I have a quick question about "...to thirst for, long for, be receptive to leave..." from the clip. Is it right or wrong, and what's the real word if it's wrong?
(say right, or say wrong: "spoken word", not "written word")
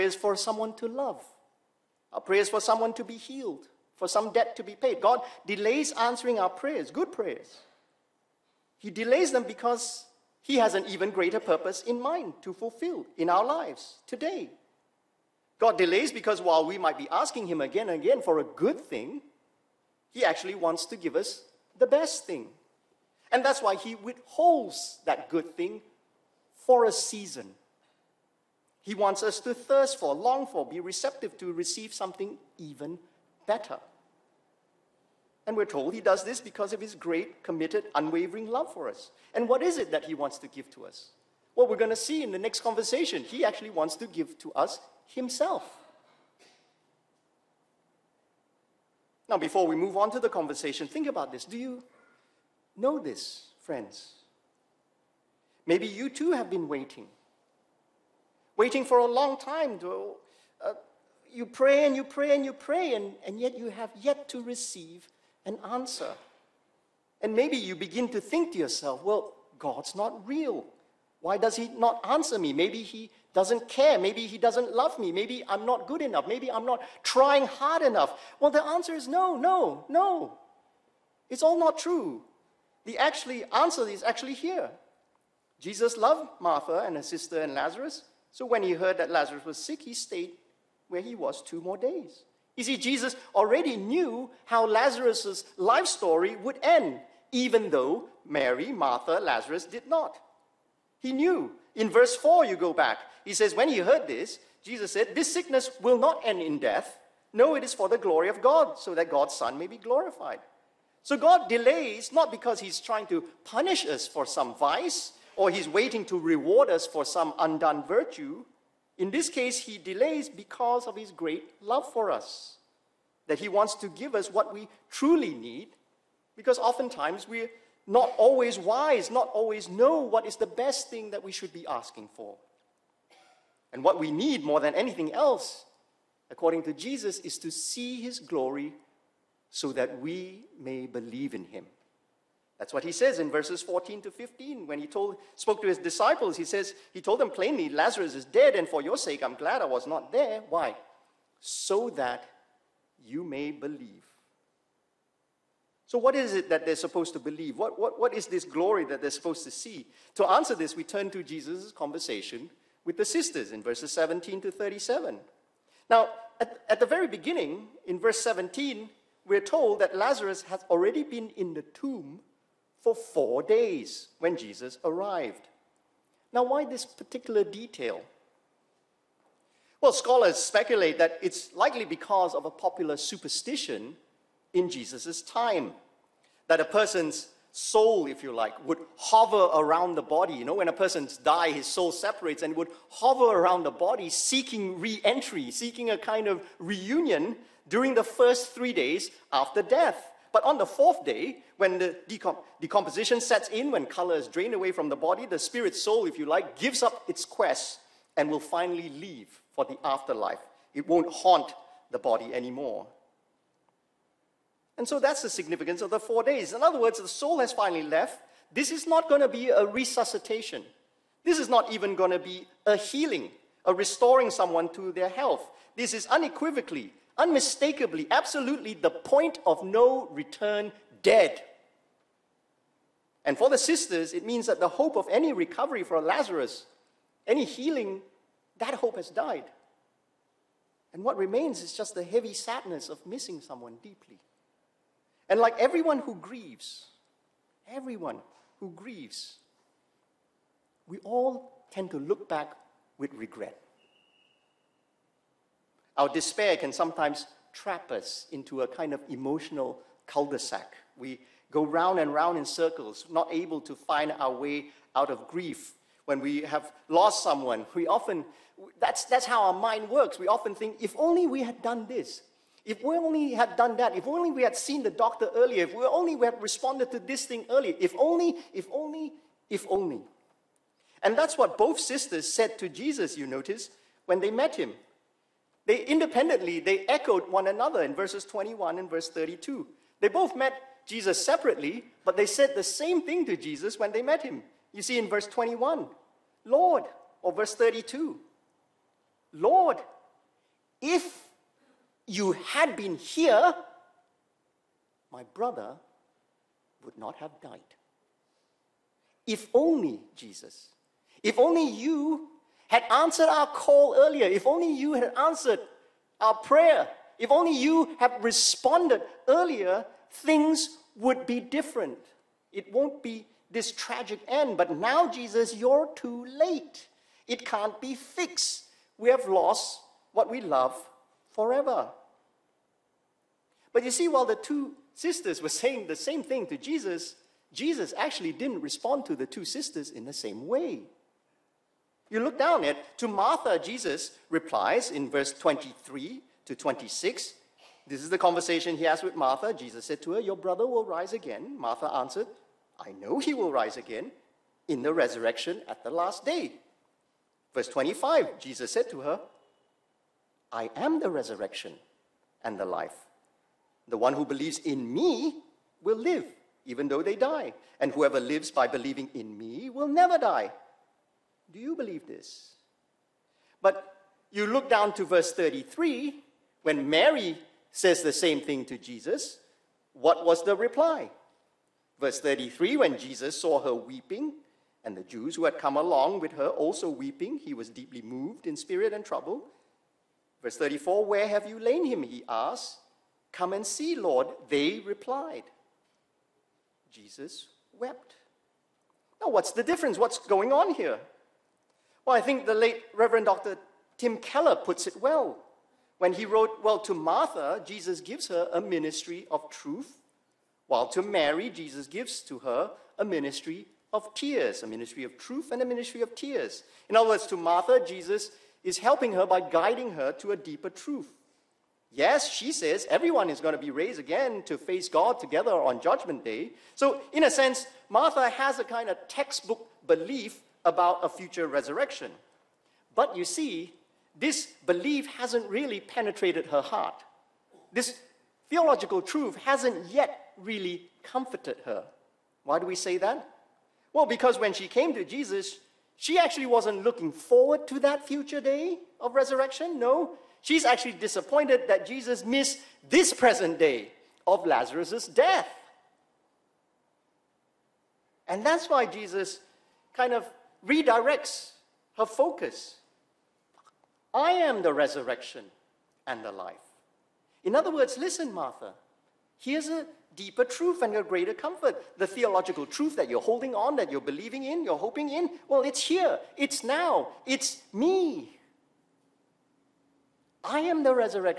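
wrong: "receive", not "leave".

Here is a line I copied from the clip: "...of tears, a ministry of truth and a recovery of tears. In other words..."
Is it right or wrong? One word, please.
wrong.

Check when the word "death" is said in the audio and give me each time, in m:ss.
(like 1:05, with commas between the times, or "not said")
1:46, 3:19, 7:35.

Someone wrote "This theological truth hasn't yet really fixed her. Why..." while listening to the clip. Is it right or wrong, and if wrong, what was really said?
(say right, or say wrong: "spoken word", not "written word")
wrong: "comforted", not "fixed".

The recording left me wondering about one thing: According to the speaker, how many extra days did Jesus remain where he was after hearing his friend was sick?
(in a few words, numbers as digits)
2.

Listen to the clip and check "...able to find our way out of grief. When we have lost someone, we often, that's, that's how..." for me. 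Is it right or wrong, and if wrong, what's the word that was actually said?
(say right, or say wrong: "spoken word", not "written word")
right.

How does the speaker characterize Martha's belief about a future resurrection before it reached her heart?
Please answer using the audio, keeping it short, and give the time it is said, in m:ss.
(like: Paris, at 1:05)
textbook belief, at 7:09.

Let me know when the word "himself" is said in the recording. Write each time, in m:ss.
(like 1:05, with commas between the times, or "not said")
0:45.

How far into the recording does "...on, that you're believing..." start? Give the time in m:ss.
7:53.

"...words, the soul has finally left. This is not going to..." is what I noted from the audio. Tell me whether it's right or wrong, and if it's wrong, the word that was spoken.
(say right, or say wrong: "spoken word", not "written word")
right.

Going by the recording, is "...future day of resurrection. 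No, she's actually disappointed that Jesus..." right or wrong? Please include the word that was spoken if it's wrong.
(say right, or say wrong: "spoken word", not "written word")
right.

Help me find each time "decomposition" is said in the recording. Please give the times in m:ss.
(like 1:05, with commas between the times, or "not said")
3:22.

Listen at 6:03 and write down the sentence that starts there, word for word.
The one who believes in me will live, even though they die.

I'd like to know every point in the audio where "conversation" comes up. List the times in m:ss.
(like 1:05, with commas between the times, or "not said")
0:42, 0:50, 2:41, 5:48.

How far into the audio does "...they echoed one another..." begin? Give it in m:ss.
4:46.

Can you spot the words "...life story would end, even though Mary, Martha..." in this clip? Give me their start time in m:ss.
1:35.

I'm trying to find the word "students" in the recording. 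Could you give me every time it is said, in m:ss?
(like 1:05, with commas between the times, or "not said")
not said.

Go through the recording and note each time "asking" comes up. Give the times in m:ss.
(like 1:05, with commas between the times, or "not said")
0:17, 2:11.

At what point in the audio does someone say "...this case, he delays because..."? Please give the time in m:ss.
1:59.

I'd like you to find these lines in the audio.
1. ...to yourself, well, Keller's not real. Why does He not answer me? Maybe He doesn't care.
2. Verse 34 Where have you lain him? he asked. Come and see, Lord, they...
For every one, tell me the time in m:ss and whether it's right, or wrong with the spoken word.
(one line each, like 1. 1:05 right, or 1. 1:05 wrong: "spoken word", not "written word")
1. 1:08 wrong: "God", not "Keller"
2. 6:30 right.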